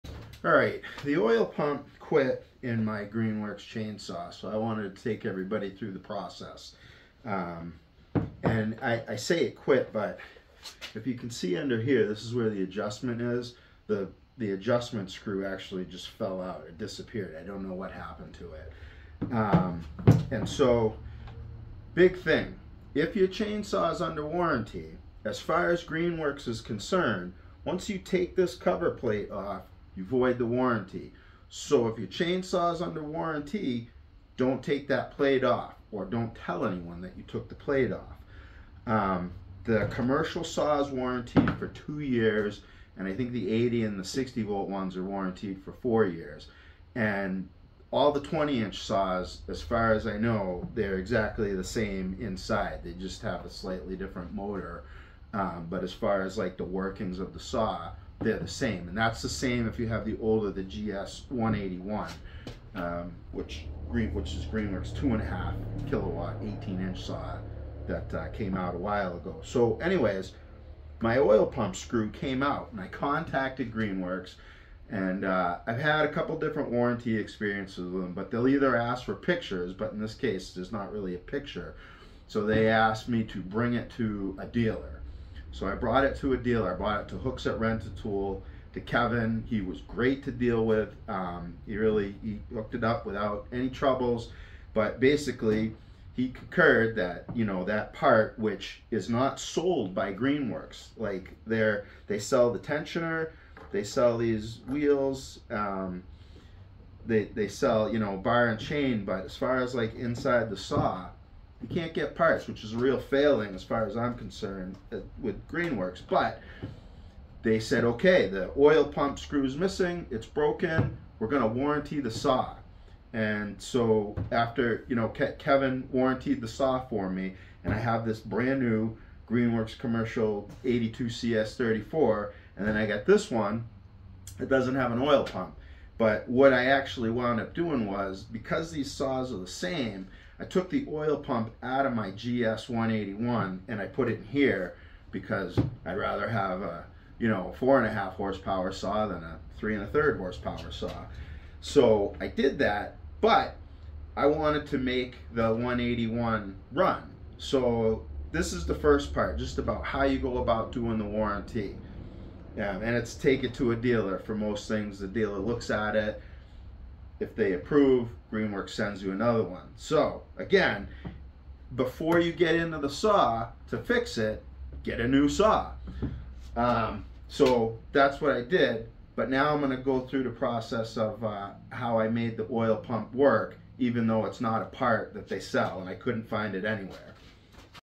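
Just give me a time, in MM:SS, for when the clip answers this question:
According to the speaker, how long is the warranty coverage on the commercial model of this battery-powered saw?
00:41.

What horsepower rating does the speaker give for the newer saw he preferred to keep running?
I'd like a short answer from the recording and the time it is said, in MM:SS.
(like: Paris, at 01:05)
4.5 horsepower, at 02:27.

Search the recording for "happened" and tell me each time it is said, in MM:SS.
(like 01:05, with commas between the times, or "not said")
00:17.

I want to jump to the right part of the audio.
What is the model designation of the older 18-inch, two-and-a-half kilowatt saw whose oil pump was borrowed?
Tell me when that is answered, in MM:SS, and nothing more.
01:00.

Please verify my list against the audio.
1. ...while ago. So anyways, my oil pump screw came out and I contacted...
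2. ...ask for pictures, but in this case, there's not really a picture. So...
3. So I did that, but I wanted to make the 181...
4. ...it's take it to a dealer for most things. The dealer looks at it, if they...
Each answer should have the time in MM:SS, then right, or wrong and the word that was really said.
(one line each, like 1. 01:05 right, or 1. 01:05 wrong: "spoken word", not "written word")
1. 01:08 right
2. 01:18 right
3. 02:31 right
4. 02:42 right.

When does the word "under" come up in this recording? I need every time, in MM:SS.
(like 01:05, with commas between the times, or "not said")
00:11, 00:24, 00:32.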